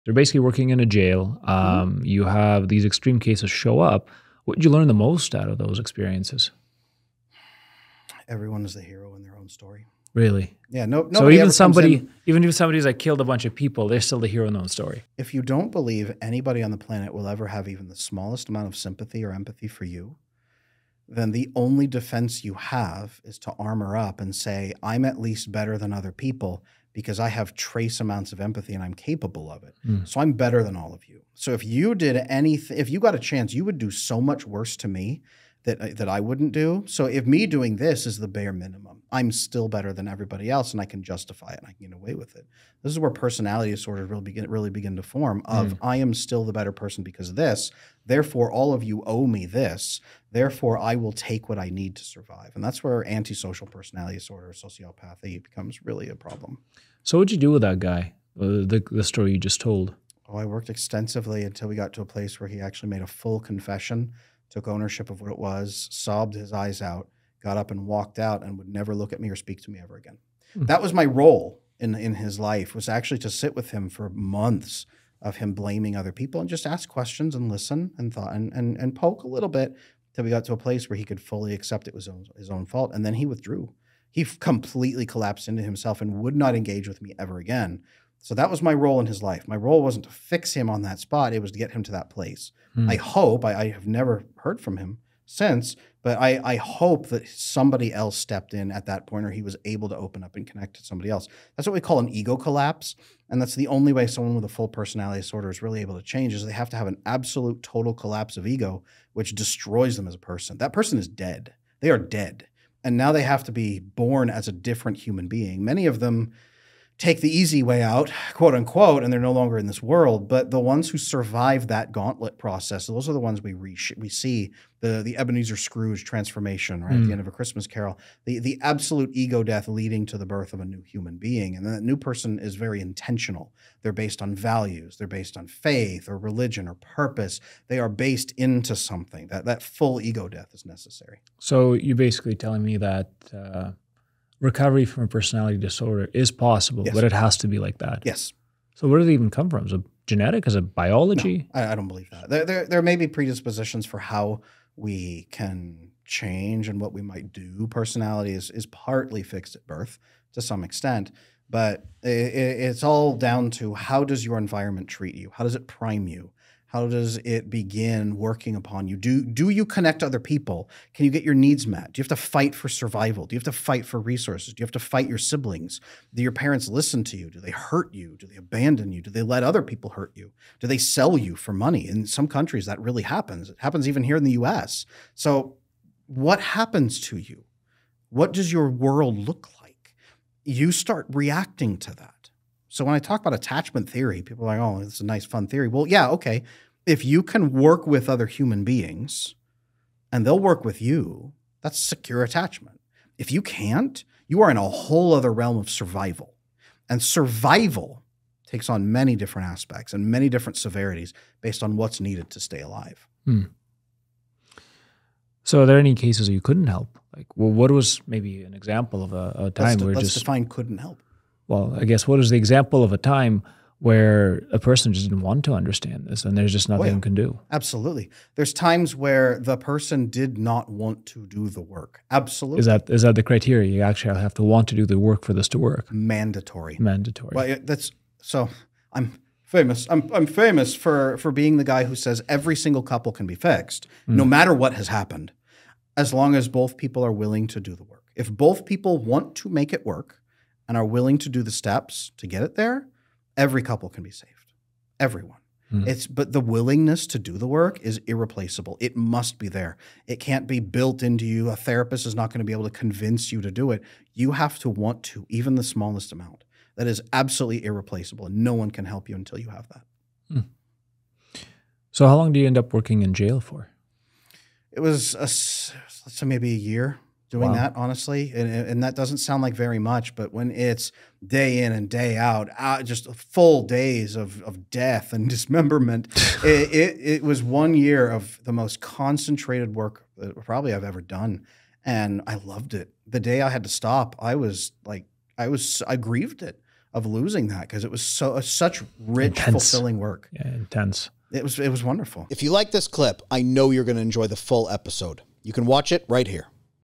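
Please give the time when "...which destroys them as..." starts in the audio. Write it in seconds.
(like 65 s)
109 s.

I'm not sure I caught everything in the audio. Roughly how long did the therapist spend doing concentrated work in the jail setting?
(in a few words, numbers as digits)
A year.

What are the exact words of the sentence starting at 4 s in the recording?
What did you learn the most out of those experiences?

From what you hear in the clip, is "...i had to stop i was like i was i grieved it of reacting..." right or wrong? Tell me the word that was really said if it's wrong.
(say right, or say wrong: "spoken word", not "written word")
wrong: "losing", not "reacting".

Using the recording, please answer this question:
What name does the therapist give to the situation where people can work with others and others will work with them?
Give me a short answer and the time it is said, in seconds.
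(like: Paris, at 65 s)
Secure attachment, at 201 s.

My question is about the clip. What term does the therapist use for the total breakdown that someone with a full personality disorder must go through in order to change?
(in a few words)
Ego collapse.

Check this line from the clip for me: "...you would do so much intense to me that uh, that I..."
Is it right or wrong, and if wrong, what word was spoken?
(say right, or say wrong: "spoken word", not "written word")
wrong: "worse", not "intense".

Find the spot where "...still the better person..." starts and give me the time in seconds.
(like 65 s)
46 s.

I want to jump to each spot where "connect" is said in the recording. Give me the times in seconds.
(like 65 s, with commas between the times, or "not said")
100 s, 169 s.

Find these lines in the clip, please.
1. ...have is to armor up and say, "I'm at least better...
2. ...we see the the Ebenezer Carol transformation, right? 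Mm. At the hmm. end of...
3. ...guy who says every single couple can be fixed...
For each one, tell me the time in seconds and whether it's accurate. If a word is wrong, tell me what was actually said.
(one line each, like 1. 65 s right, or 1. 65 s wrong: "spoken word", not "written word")
1. 22 s right
2. 123 s wrong: "Scrooge", not "Carol"
3. 241 s right.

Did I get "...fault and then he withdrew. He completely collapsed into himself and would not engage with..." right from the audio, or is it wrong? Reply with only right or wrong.
right.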